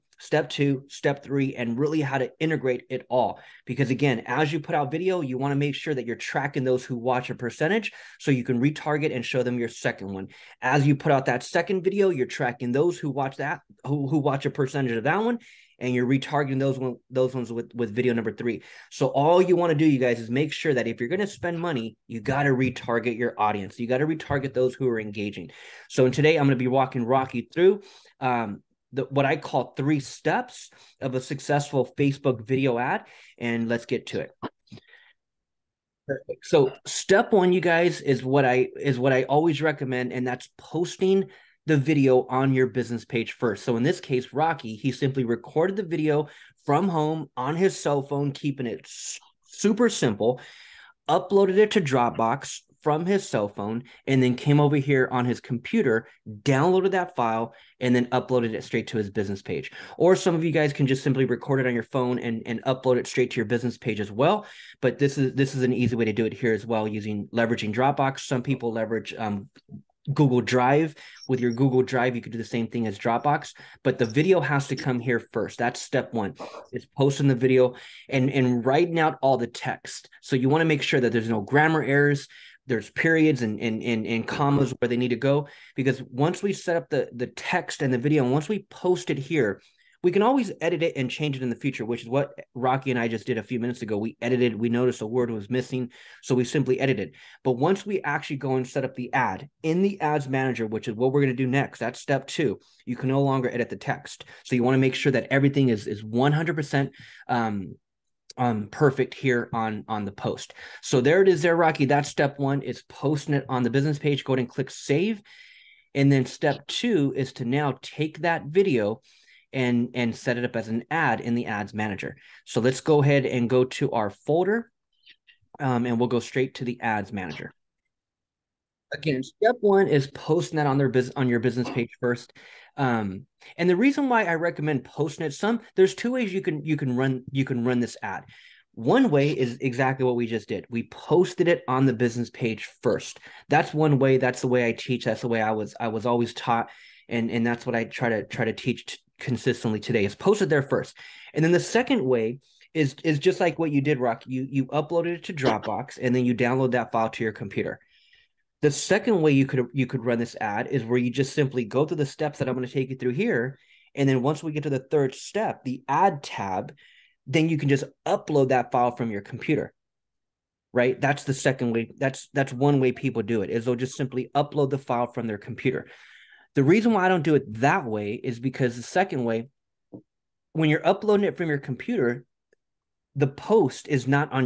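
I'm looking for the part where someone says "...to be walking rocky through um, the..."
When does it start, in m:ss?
0:26.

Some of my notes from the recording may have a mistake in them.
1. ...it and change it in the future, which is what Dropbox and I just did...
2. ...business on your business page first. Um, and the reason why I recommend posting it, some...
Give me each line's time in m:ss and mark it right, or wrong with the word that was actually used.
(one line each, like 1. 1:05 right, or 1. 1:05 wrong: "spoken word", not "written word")
1. 1:30 wrong: "Rocky", not "Dropbox"
2. 2:10 right.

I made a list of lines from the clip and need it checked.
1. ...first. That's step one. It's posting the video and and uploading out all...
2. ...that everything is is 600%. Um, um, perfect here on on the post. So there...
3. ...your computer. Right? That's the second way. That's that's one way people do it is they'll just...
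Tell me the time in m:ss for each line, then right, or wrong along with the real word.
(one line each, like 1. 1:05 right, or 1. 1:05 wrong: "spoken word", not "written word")
1. 1:15 wrong: "writing", not "uploading"
2. 1:45 wrong: "100", not "600"
3. 2:49 right.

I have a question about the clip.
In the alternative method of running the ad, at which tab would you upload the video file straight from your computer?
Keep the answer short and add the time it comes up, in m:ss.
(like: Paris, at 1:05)
the ad tab, at 2:45.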